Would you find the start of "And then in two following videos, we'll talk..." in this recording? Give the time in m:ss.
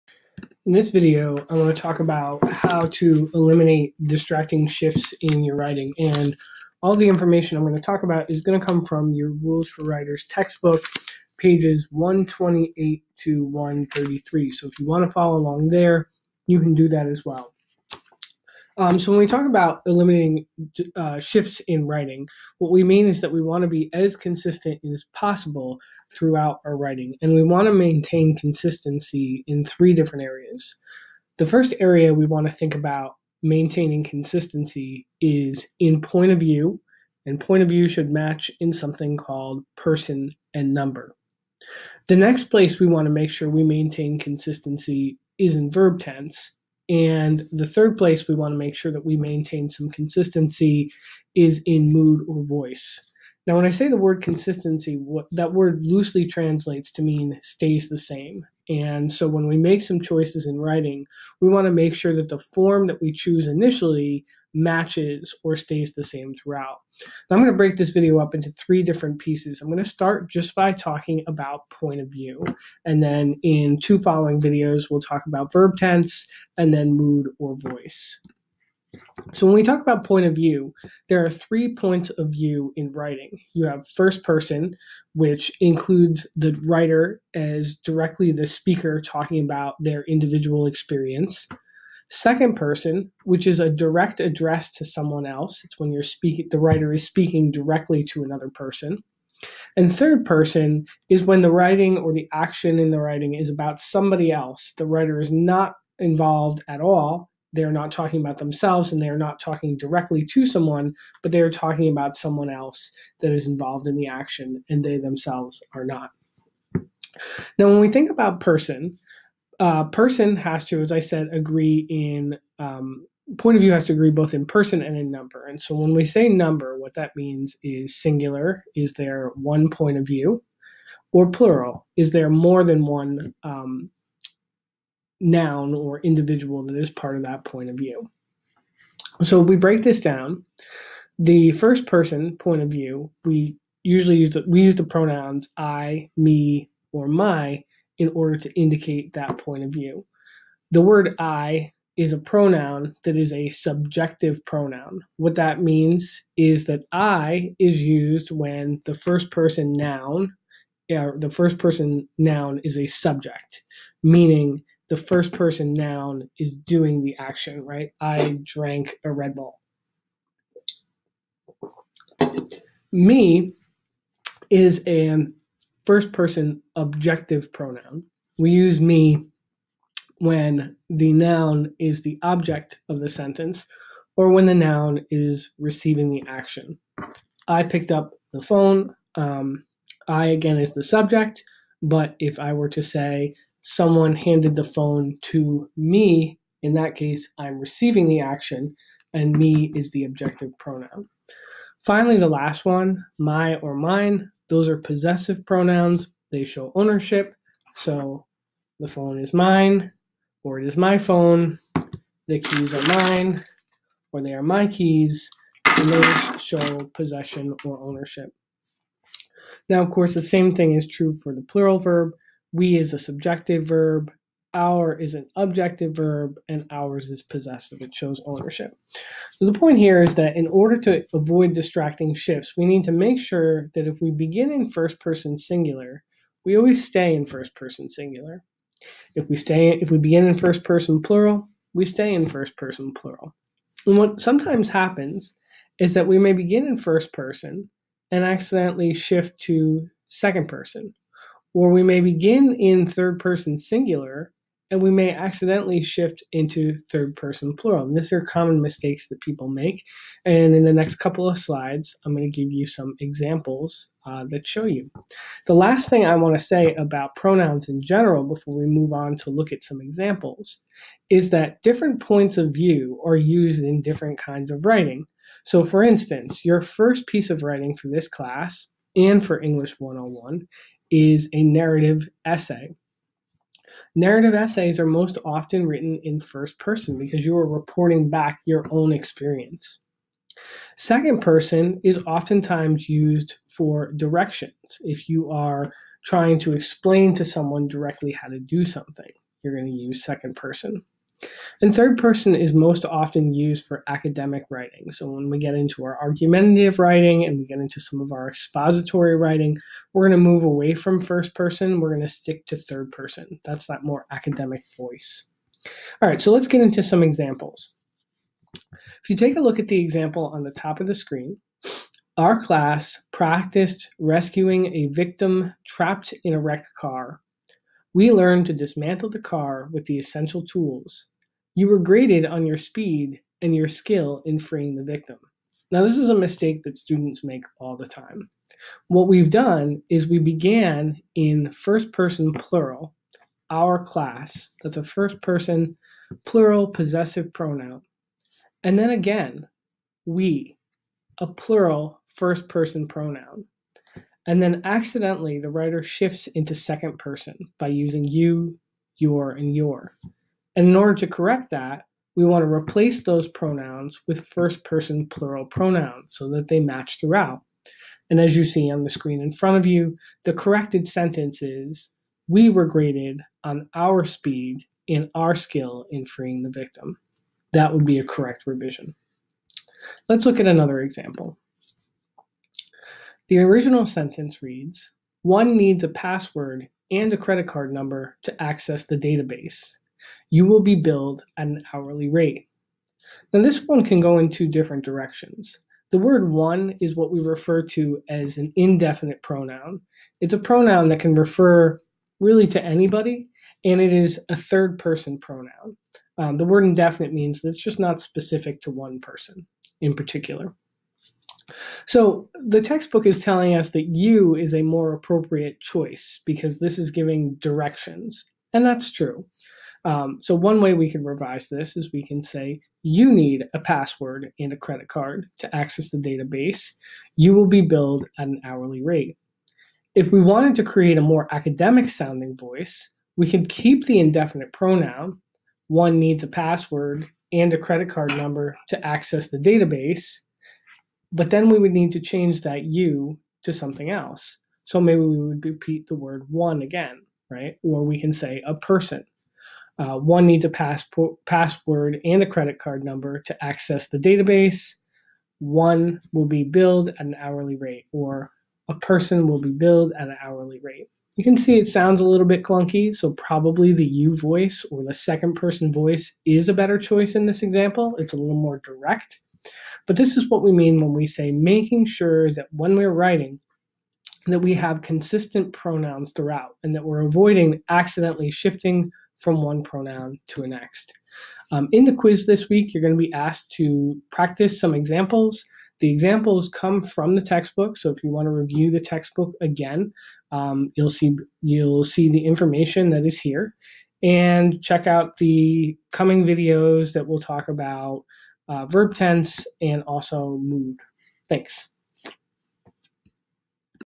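1:12.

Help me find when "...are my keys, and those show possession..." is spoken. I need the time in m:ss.
3:34.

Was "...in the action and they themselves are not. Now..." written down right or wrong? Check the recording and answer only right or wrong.
right.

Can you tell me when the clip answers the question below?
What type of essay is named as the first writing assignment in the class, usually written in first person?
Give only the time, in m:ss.
4:41.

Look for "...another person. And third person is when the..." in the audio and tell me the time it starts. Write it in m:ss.
1:38.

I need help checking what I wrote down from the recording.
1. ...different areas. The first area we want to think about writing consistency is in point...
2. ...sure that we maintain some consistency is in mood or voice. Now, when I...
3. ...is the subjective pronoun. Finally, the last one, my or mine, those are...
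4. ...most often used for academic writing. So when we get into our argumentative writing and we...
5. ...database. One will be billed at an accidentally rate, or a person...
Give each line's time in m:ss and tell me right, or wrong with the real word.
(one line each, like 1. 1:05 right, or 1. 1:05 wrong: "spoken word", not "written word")
1. 0:29 wrong: "maintaining", not "writing"
2. 0:48 right
3. 3:19 wrong: "objective", not "subjective"
4. 5:02 right
5. 7:33 wrong: "hourly", not "accidentally".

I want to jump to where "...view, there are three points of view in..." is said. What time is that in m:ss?
1:20.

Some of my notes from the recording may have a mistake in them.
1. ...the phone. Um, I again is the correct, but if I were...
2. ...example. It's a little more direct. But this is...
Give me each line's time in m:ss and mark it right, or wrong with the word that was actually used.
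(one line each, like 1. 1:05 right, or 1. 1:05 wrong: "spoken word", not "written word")
1. 3:08 wrong: "subject", not "correct"
2. 7:47 right.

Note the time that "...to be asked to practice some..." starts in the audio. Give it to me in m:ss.
8:02.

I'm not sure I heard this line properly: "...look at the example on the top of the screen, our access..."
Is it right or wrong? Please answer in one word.
wrong.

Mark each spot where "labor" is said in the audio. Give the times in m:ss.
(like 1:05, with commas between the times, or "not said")
not said.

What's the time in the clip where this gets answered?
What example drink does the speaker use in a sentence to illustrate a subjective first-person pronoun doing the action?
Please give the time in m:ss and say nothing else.
2:49.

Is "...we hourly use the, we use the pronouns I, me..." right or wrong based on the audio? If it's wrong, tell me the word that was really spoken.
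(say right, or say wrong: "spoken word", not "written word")
wrong: "usually", not "hourly".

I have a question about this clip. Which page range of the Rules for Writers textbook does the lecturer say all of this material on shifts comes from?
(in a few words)
128 to 133.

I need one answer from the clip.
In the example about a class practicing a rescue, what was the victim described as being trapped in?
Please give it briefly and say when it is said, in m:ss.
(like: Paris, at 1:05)
A wrecked car, at 5:26.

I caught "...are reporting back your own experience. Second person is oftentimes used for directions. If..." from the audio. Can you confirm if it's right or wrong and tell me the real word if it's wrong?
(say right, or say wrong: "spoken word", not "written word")
right.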